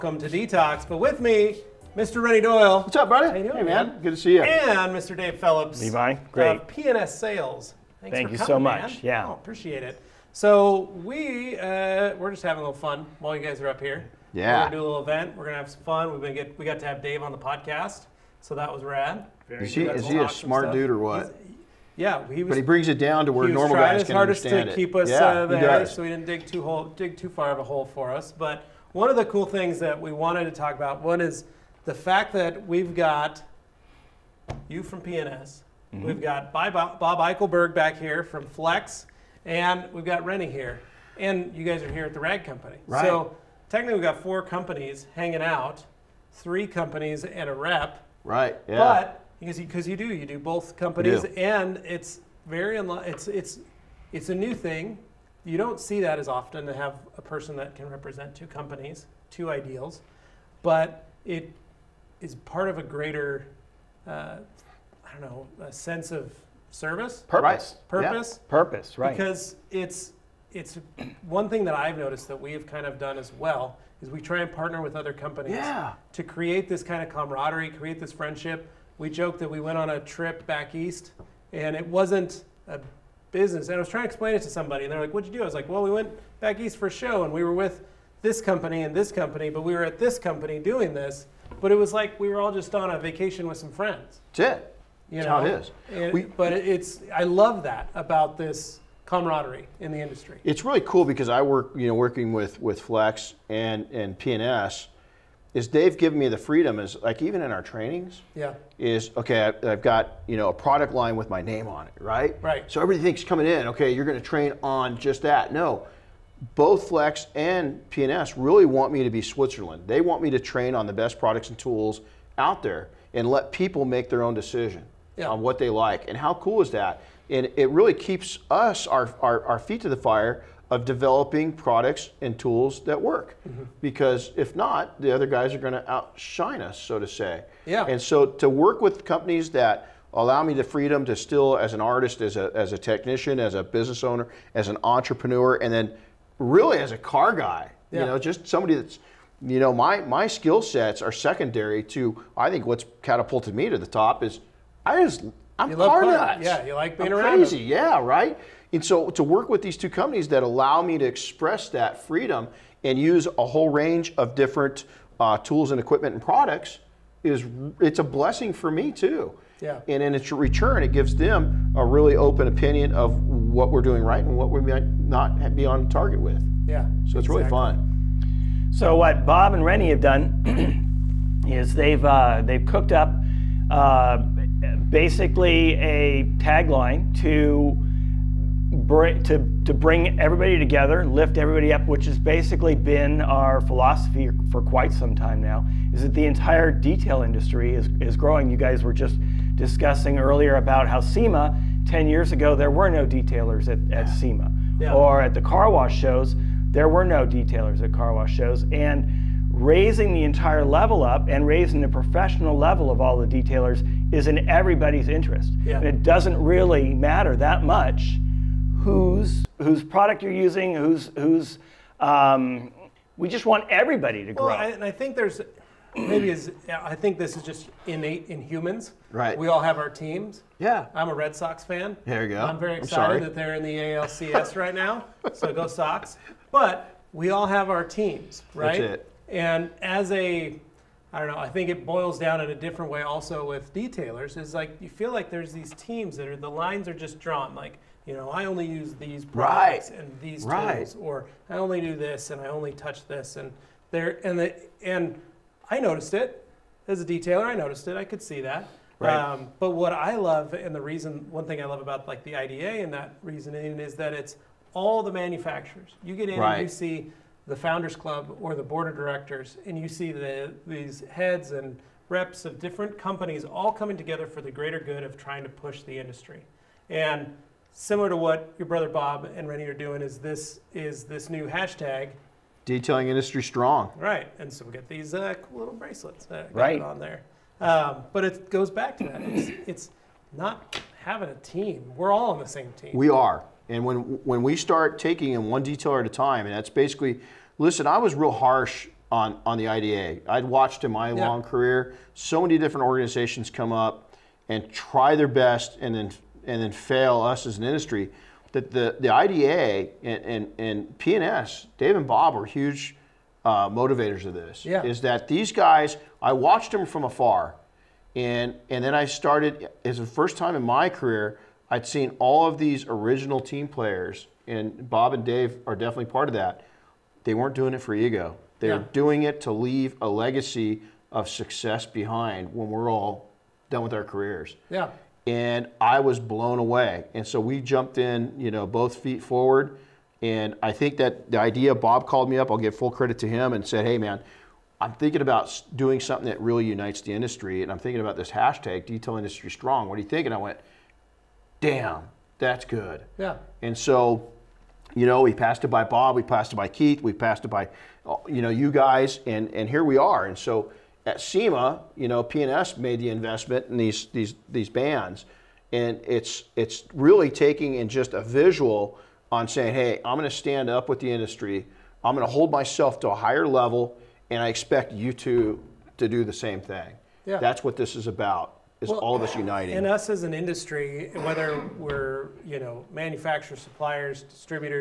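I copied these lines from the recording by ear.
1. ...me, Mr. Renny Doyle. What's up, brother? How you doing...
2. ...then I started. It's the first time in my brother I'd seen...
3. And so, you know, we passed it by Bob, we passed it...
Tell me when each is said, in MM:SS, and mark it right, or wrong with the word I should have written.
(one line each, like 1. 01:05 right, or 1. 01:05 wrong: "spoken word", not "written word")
1. 00:01 right
2. 05:18 wrong: "career", not "brother"
3. 05:53 right.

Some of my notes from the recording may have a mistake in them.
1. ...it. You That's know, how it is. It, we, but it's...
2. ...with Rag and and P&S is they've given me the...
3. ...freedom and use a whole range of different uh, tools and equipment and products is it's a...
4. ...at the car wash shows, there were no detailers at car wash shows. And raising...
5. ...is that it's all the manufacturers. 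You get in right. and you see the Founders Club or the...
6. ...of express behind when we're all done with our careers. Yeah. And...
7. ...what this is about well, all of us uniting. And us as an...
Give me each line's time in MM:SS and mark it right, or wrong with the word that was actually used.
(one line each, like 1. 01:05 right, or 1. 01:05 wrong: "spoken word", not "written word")
1. 01:34 right
2. 01:42 wrong: "Flex", not "Rag"
3. 02:42 right
4. 03:25 right
5. 04:23 right
6. 05:31 wrong: "success", not "express"
7. 06:17 right.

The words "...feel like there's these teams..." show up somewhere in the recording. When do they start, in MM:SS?
04:04.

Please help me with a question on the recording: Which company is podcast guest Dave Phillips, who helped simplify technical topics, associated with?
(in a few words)
P&S Sales.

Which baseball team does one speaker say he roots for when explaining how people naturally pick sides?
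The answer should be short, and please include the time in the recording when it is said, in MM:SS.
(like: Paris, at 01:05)
Red Sox, at 03:51.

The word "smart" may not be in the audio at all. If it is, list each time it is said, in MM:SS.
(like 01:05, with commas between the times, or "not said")
00:20.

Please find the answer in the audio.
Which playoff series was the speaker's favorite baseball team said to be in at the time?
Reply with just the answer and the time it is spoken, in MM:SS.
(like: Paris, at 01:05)
ALCS, at 03:53.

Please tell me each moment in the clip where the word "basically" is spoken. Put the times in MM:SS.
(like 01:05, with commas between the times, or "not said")
03:04, 03:12, 04:56.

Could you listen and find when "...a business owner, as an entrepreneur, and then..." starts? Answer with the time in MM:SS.
02:23.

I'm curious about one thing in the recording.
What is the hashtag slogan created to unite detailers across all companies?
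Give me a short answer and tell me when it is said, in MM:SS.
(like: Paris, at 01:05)
Detail Industry Strong, at 05:48.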